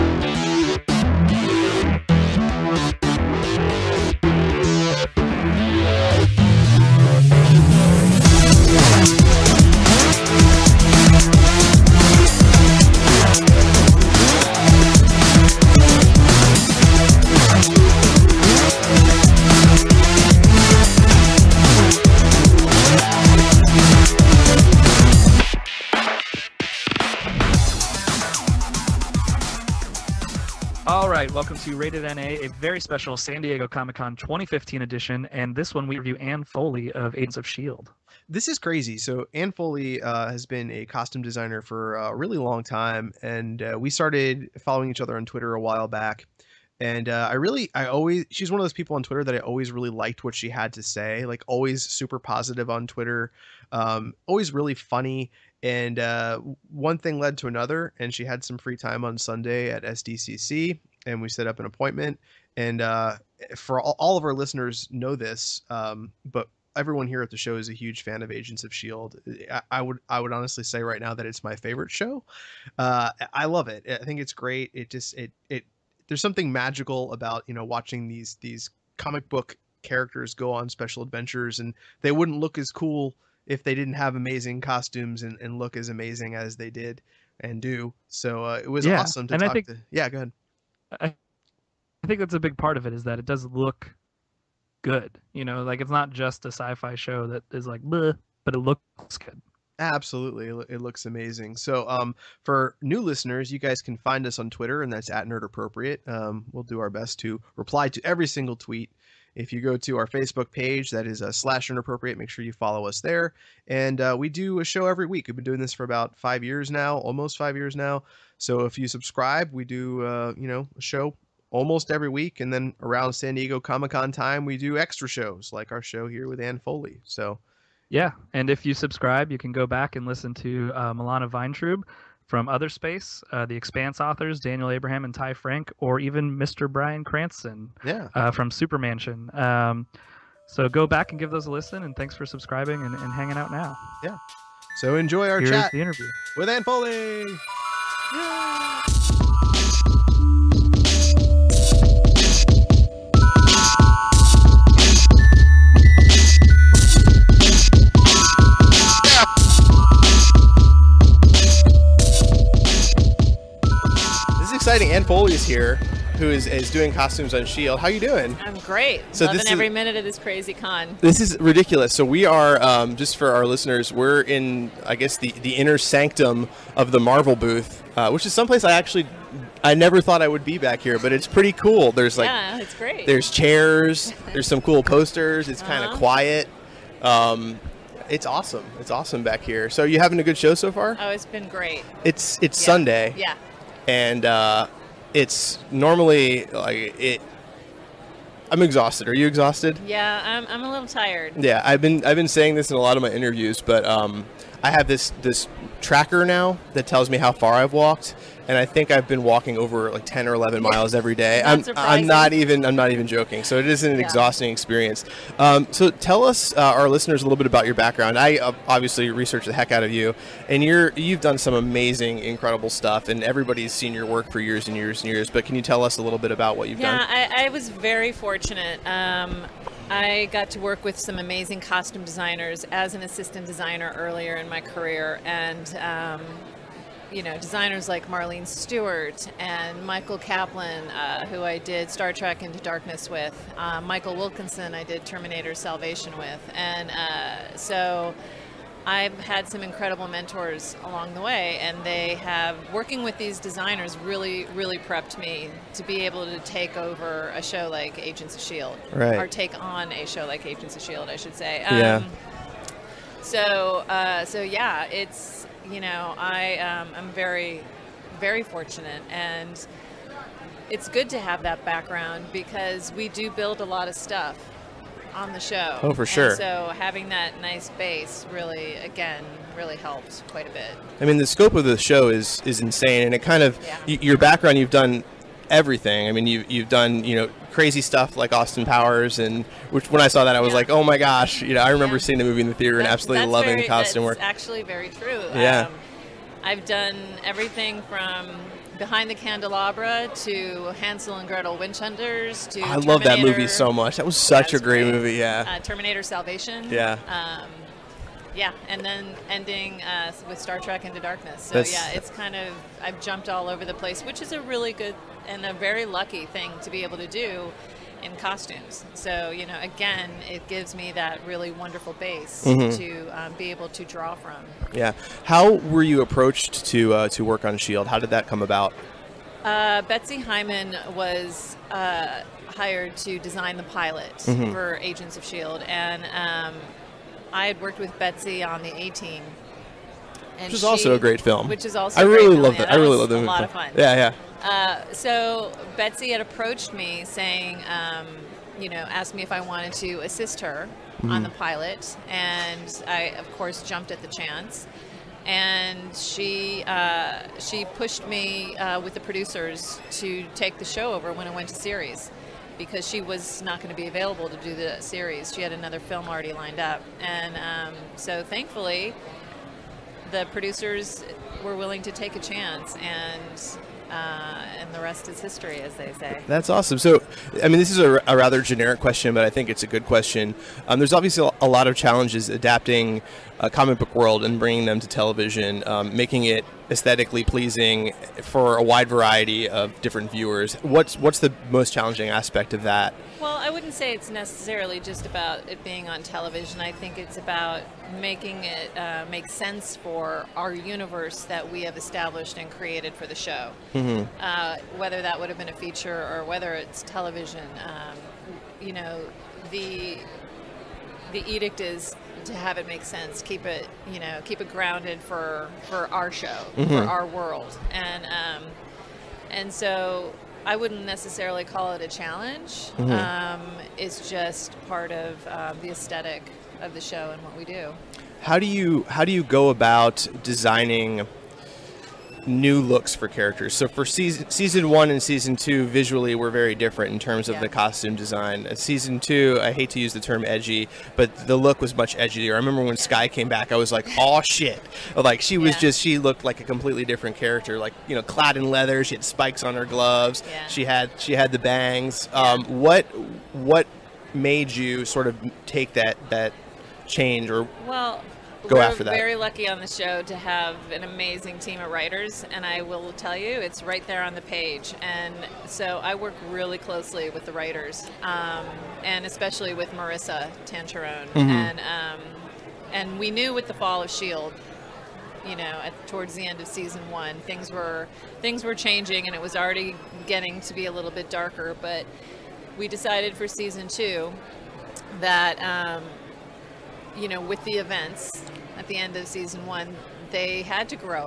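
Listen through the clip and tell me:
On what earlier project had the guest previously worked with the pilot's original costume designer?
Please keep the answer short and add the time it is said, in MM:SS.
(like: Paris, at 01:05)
The A Team, at 05:38.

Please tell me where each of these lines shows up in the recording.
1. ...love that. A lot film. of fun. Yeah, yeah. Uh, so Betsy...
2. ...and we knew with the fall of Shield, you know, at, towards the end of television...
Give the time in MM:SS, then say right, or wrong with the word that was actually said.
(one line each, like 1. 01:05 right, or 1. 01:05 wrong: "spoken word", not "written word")
1. 05:42 right
2. 07:52 wrong: "season", not "television".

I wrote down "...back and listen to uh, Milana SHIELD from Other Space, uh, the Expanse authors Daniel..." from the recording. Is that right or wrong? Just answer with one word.
wrong.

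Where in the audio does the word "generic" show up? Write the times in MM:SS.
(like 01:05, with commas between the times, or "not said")
06:18.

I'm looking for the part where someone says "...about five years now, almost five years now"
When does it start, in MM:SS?
01:55.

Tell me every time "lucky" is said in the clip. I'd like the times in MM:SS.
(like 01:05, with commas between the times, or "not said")
05:15, 07:39.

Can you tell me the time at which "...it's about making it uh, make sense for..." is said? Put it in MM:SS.
06:36.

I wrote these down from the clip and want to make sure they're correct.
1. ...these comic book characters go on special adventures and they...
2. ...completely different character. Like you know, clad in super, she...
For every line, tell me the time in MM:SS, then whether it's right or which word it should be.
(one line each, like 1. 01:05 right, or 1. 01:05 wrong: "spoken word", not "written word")
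1. 01:18 right
2. 07:26 wrong: "leather", not "super".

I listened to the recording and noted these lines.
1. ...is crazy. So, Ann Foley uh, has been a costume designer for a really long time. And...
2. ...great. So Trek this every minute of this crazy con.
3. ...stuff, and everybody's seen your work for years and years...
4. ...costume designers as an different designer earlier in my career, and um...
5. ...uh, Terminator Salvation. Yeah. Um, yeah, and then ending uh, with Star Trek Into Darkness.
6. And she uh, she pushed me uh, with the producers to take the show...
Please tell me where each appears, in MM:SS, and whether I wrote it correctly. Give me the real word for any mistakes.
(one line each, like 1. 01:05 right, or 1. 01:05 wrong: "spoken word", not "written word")
1. 00:38 right
2. 02:48 wrong: "Loving", not "Trek"
3. 03:42 right
4. 03:51 wrong: "assistant", not "different"
5. 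05:05 right
6. 05:55 right.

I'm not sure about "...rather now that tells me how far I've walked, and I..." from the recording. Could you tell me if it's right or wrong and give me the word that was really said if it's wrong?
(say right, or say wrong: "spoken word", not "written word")
wrong: "tracker", not "rather".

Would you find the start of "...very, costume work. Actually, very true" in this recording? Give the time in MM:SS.
04:53.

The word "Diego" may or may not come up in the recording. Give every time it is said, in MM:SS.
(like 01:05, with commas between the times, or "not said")
00:33, 02:03.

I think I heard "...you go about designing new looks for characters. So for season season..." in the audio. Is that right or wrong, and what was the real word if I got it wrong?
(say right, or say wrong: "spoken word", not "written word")
right.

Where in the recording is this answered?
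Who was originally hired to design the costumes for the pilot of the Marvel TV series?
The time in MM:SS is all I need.
05:29.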